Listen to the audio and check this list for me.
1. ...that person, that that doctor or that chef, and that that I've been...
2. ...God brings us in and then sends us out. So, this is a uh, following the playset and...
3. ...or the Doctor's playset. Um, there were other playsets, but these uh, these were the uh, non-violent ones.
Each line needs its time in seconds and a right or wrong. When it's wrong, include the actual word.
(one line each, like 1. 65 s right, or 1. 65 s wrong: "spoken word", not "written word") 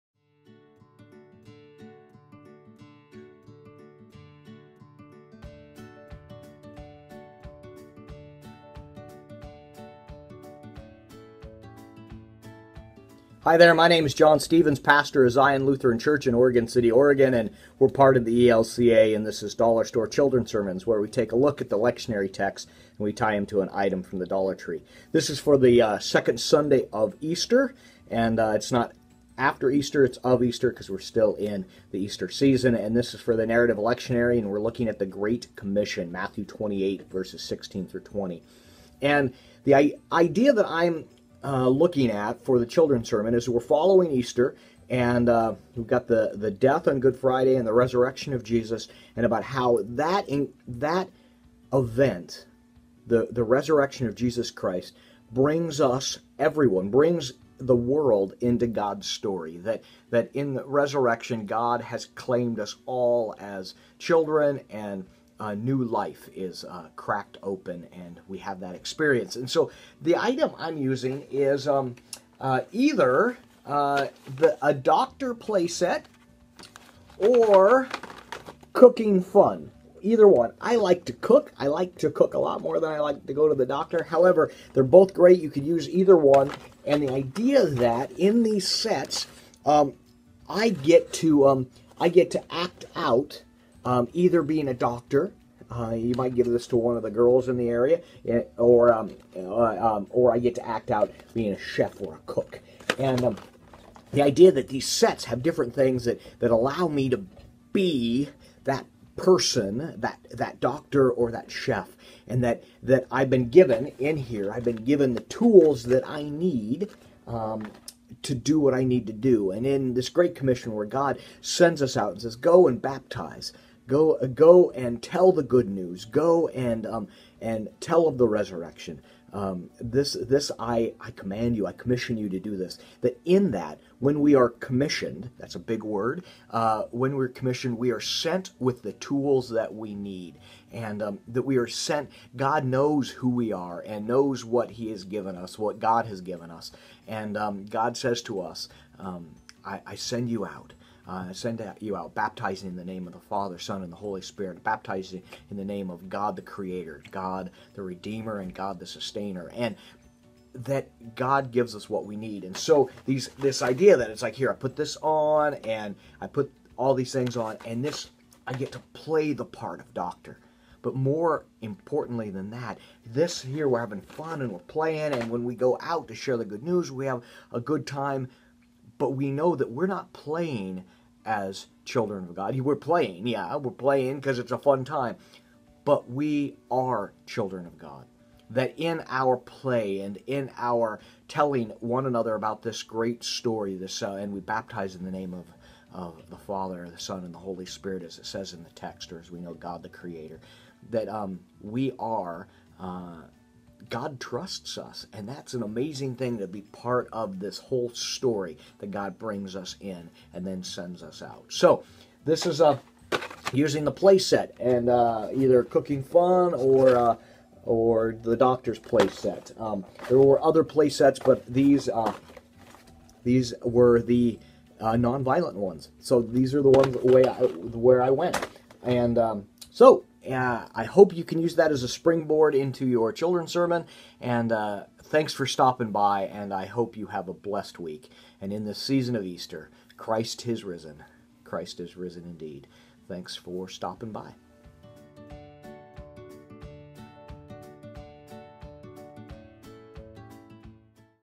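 1. 108 s right
2. 208 s wrong: "using", not "following"
3. 217 s right.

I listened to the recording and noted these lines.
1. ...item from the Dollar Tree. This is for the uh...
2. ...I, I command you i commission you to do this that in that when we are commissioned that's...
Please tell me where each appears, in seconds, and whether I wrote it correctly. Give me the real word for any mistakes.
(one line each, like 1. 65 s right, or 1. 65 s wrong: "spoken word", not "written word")
1. 23 s right
2. 130 s right.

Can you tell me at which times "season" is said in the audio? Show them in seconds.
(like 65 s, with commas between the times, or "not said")
32 s, 238 s.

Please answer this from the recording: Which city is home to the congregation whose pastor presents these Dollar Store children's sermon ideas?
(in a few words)
Oregon City.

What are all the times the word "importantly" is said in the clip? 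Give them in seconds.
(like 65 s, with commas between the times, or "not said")
171 s.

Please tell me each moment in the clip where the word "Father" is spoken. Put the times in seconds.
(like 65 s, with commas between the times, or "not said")
153 s, 196 s.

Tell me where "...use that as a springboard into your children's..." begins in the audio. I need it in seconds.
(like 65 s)
231 s.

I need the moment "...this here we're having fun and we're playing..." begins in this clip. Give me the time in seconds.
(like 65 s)
173 s.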